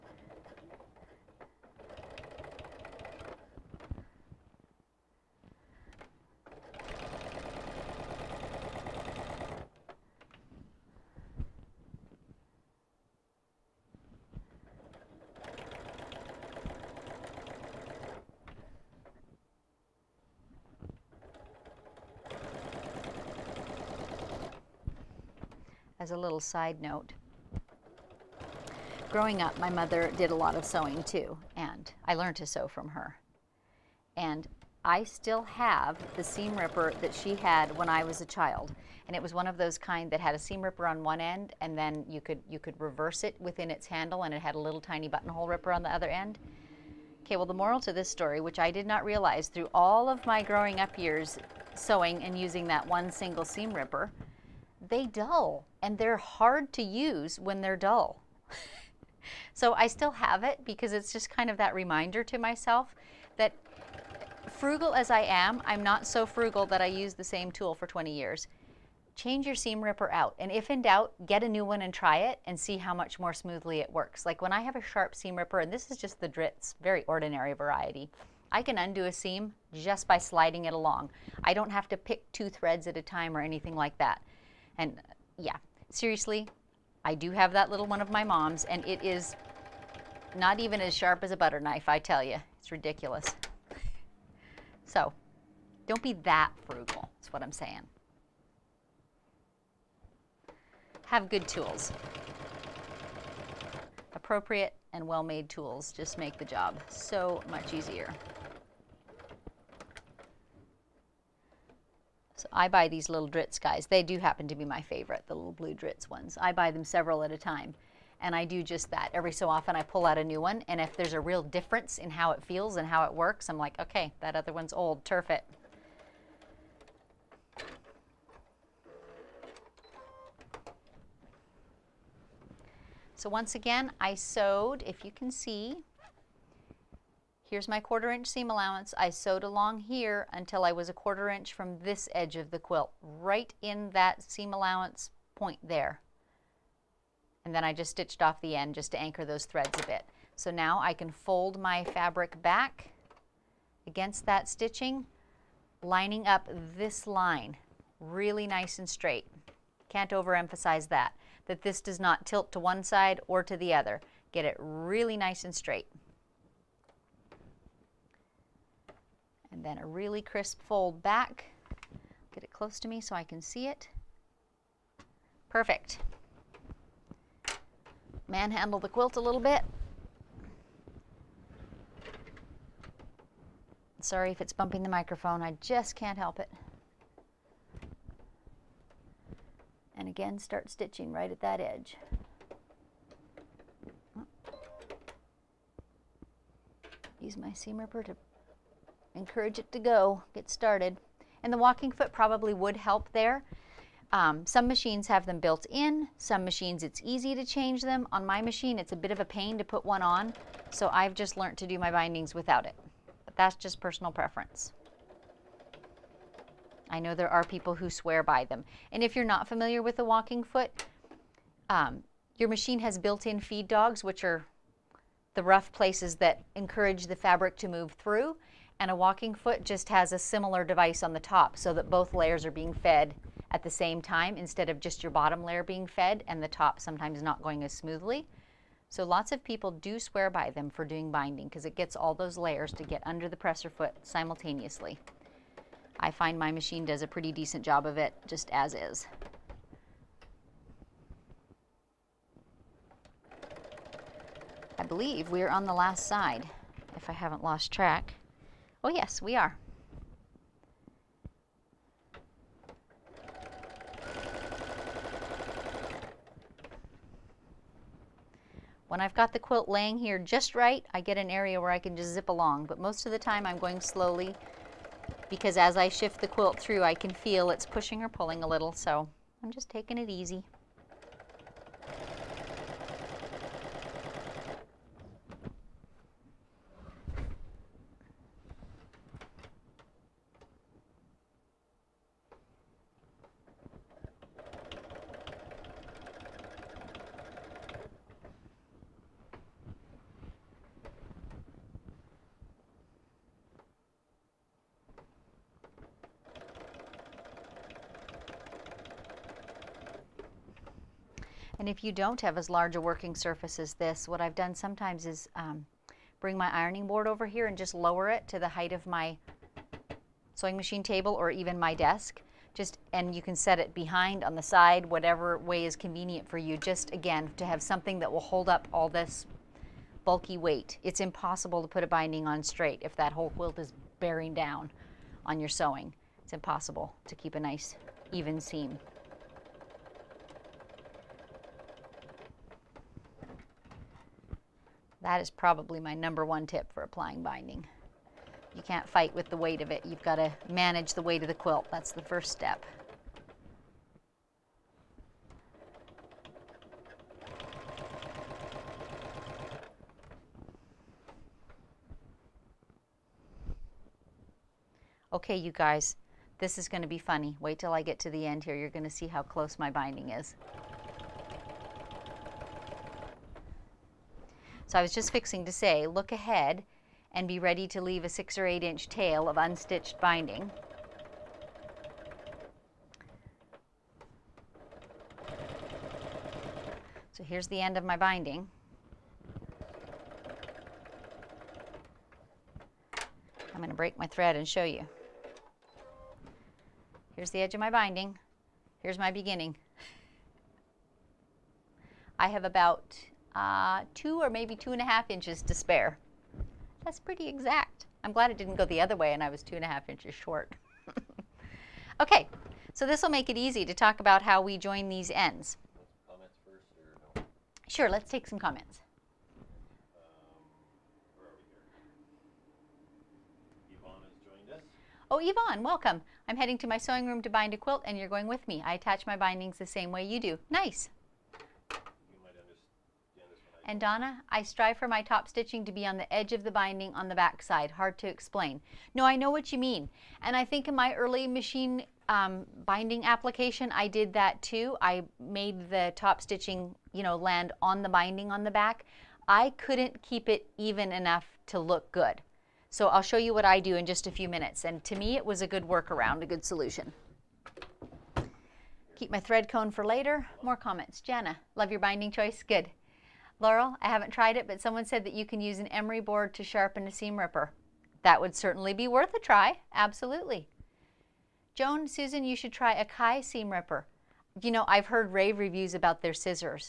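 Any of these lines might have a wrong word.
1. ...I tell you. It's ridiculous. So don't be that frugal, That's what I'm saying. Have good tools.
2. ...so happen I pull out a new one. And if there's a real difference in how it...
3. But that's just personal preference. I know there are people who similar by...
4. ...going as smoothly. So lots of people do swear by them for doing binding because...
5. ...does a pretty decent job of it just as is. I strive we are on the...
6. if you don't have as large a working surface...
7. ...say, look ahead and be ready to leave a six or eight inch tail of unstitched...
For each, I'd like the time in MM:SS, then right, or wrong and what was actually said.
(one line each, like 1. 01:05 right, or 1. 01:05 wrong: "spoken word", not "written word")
1. 01:31 right
2. 01:59 wrong: "often", not "happen"
3. 03:33 wrong: "swear", not "similar"
4. 03:57 right
5. 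04:06 wrong: "believe", not "strive"
6. 05:11 right
7. 06:15 right.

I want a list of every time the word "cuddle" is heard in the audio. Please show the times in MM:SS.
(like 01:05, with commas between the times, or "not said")
not said.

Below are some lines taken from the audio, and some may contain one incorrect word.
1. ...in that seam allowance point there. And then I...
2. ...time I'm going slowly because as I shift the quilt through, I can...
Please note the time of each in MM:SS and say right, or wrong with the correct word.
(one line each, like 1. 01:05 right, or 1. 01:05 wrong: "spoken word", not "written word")
1. 02:23 right
2. 04:33 right.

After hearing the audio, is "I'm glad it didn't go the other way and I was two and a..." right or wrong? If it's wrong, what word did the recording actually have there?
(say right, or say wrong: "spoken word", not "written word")
right.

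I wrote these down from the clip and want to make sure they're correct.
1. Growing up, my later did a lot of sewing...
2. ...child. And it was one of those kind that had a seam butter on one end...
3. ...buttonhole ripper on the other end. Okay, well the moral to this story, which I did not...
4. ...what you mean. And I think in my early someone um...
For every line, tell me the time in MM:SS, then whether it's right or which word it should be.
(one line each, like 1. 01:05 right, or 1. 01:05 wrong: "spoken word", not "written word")
1. 00:29 wrong: "mother", not "later"
2. 00:38 wrong: "ripper", not "butter"
3. 00:45 right
4. 07:19 wrong: "machine", not "someone".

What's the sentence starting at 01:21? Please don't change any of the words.
I don't have to pick two threads at a time or anything like that.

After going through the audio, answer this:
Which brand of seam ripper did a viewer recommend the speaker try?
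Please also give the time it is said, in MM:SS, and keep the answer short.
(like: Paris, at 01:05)
Kai, at 07:52.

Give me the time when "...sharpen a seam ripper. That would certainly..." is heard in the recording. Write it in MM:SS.
07:46.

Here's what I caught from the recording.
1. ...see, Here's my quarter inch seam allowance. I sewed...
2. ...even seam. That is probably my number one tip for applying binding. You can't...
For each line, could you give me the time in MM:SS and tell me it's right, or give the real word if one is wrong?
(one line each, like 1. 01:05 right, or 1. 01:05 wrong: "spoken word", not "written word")
1. 02:15 right
2. 05:38 right.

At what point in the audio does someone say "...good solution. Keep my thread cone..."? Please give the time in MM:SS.
07:36.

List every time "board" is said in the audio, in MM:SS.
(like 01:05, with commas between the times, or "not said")
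05:16, 07:45.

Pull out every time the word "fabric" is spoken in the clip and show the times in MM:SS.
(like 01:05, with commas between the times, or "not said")
02:31, 03:47.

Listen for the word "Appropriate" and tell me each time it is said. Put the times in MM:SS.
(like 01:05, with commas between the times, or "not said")
01:44.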